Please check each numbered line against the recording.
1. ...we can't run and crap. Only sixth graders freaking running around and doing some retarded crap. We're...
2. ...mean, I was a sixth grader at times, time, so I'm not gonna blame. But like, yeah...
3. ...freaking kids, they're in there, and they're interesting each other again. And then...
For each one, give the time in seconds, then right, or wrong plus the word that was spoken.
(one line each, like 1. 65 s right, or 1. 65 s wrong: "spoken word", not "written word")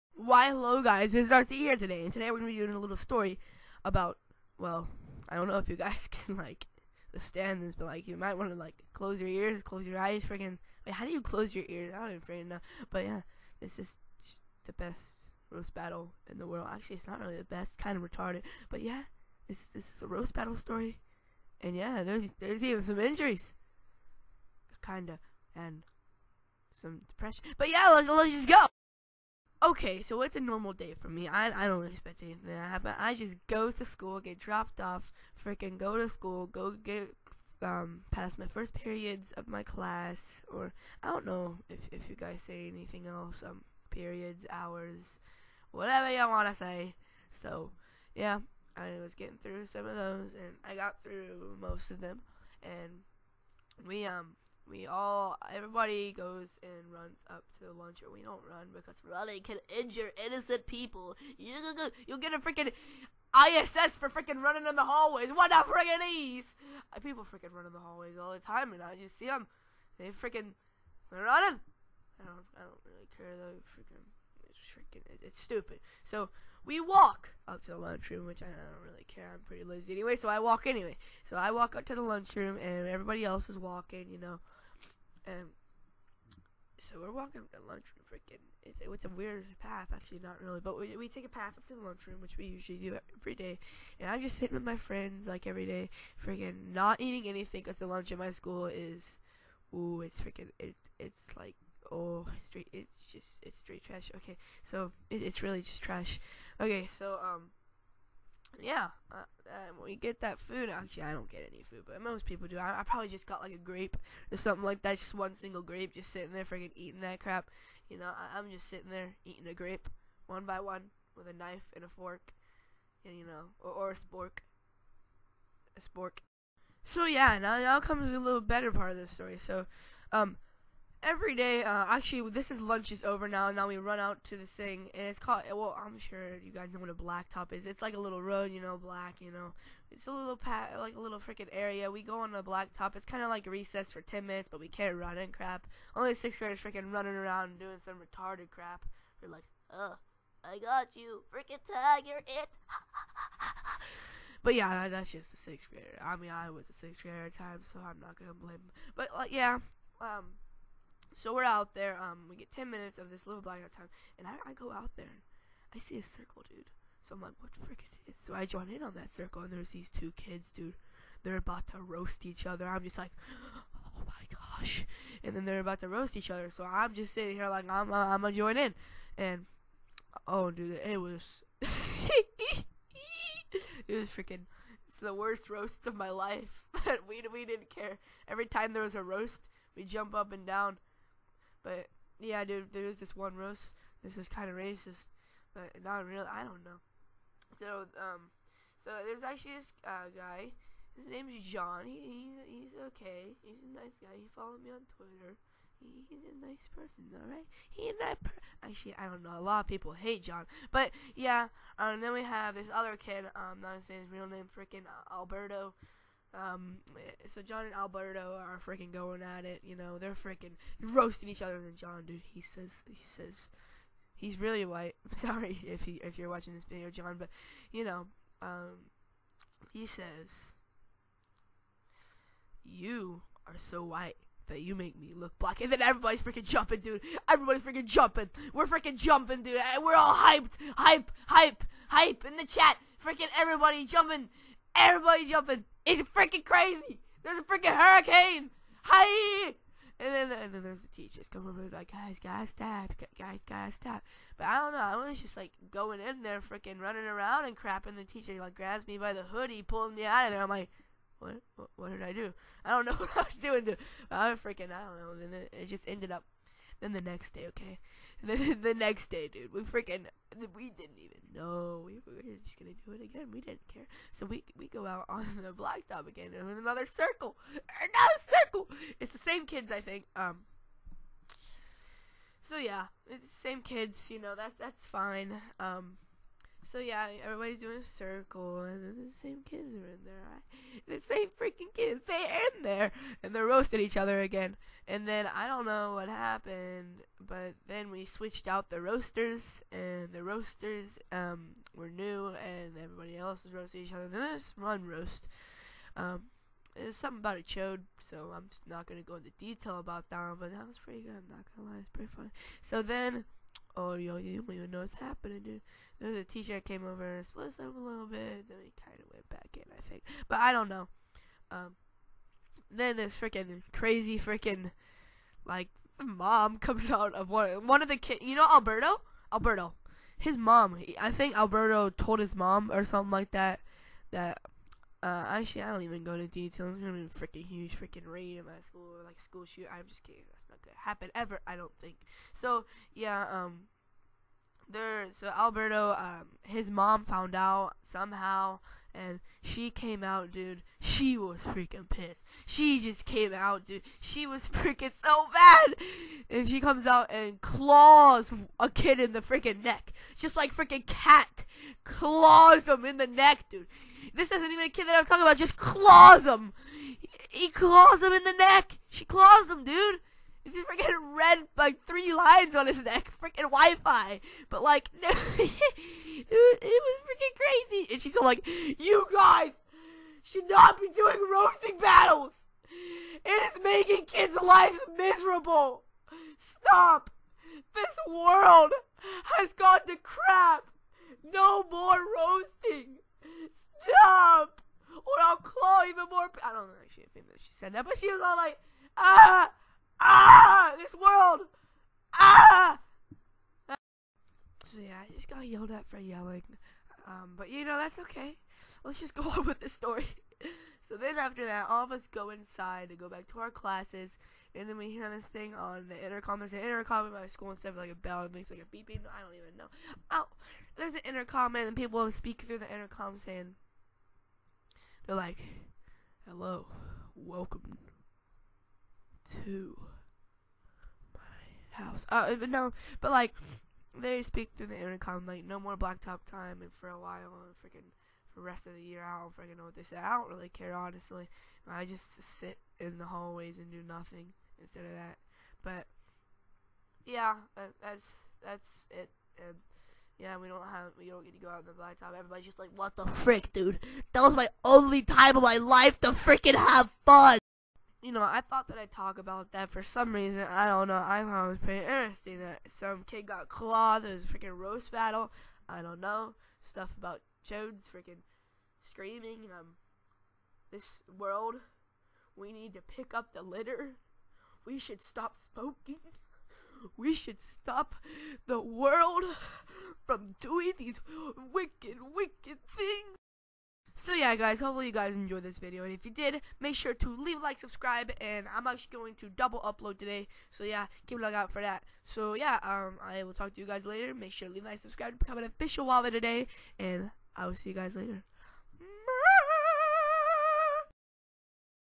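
1. 144 s right
2. 156 s right
3. 291 s wrong: "roasting", not "interesting".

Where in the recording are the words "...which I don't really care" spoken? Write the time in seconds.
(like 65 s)
78 s.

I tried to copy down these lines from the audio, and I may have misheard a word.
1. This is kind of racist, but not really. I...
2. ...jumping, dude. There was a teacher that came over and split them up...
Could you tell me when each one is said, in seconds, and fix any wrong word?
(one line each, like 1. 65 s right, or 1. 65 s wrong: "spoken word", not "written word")
1. 194 s right
2. 314 s wrong: "happening", not "jumping".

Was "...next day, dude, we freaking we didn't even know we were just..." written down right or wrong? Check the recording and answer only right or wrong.
right.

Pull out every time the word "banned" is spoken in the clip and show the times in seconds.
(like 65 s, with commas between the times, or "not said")
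not said.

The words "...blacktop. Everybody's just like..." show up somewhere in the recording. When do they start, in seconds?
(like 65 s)
451 s.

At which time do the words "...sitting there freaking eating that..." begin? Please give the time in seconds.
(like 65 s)
116 s.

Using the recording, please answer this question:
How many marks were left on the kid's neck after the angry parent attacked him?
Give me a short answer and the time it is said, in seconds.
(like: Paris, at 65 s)
3, at 371 s.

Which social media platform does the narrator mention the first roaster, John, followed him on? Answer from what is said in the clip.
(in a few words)
Twitter.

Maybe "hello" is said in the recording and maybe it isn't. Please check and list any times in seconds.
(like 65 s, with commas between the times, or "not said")
0 s, 426 s.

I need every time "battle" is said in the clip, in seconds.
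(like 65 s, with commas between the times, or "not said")
15 s, 20 s, 381 s, 464 s.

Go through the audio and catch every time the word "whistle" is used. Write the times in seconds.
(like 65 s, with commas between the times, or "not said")
not said.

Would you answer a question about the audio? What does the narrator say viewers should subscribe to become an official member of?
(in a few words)
WaVa.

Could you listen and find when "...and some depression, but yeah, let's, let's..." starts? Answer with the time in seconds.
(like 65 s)
25 s.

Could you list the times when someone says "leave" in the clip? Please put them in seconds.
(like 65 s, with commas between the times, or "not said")
487 s, 494 s.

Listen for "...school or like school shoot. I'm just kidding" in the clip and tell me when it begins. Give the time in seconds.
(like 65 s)
338 s.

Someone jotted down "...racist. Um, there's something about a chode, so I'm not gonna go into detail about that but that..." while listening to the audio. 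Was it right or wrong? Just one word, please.
wrong.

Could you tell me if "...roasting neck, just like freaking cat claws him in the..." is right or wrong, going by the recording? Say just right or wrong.
wrong.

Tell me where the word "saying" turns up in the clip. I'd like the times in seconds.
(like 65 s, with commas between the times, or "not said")
213 s, 423 s.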